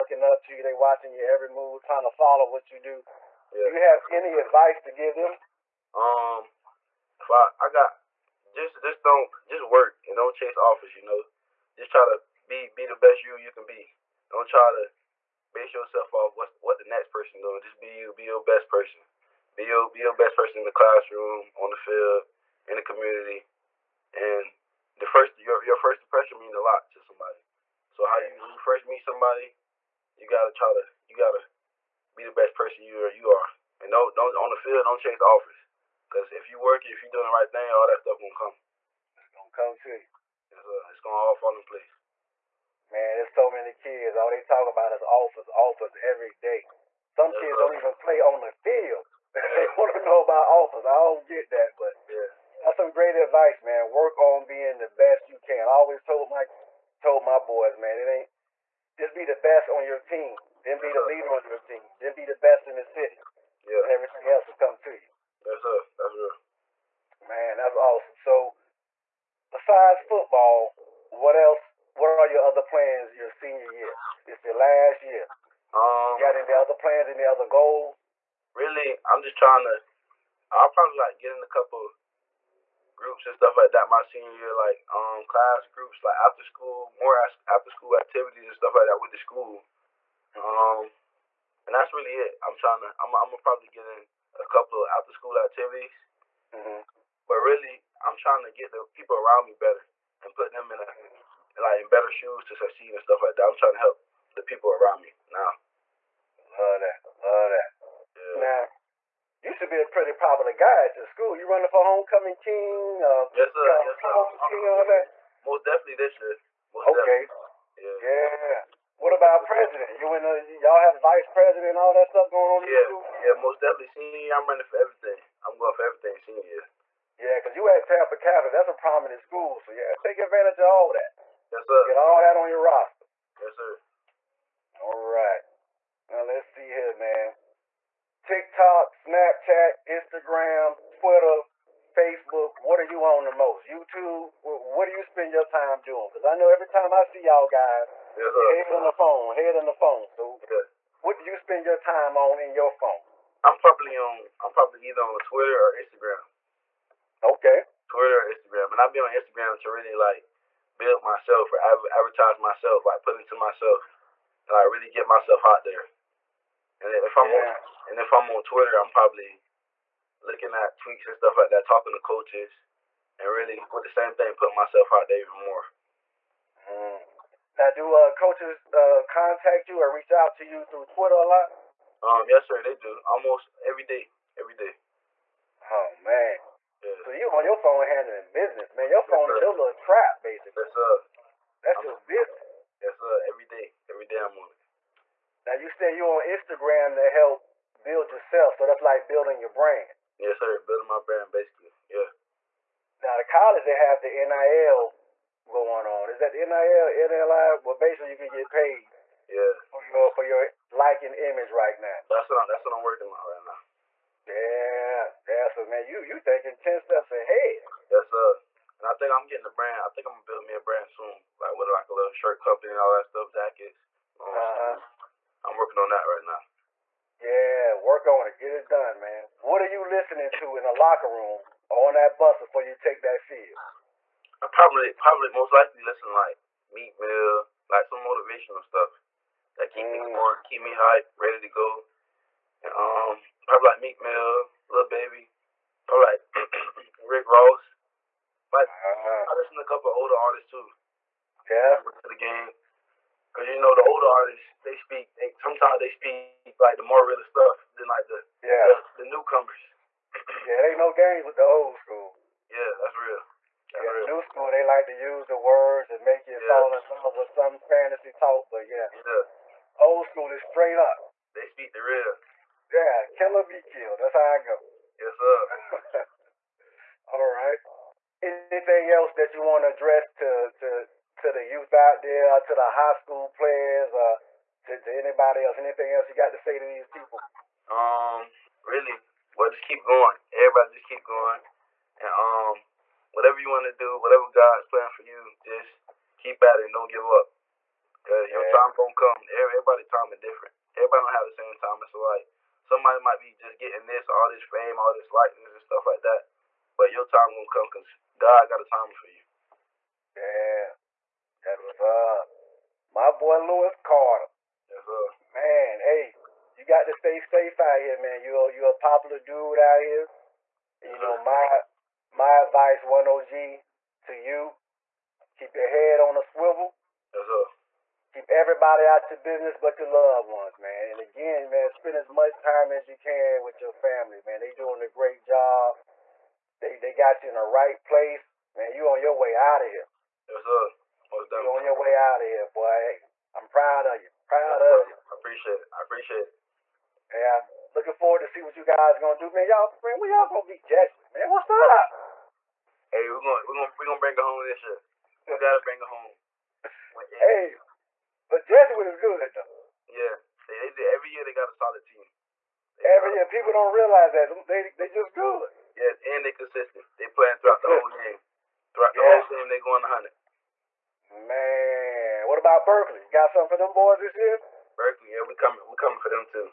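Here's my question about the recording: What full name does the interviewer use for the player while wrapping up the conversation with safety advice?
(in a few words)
Lewis Carter.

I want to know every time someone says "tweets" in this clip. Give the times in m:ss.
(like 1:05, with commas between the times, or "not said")
2:50.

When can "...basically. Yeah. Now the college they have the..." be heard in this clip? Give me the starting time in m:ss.
3:21.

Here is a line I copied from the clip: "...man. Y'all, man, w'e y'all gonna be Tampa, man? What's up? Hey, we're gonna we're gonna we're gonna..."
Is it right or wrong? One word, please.
wrong.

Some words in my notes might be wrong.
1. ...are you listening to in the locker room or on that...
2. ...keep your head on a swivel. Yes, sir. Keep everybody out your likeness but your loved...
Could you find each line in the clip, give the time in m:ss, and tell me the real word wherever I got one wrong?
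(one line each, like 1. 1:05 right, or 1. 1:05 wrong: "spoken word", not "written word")
1. 3:49 right
2. 5:25 wrong: "business", not "likeness".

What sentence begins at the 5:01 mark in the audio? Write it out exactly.
It's so like somebody might be just getting this, all this fame, all this likeness and stuff like that.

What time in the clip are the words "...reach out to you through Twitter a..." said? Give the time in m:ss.
2:59.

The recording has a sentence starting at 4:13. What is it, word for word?
Cause you know the older artists, they speak.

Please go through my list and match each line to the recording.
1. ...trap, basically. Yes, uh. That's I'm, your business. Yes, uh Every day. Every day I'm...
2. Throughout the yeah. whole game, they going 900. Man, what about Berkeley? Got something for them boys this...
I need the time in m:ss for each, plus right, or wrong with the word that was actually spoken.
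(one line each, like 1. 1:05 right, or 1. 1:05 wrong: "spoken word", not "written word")
1. 3:09 right
2. 6:08 wrong: "100", not "900".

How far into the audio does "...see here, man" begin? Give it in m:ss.
2:16.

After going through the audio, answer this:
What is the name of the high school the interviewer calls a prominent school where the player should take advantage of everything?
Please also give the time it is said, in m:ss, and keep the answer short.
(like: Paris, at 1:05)
Tampa Catholic, at 2:07.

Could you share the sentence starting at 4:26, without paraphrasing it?
fall in love with some fantasy talk, but yeah, yeah, old school is straight up.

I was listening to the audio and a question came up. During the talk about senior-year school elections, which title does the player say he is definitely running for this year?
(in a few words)
Homecoming king.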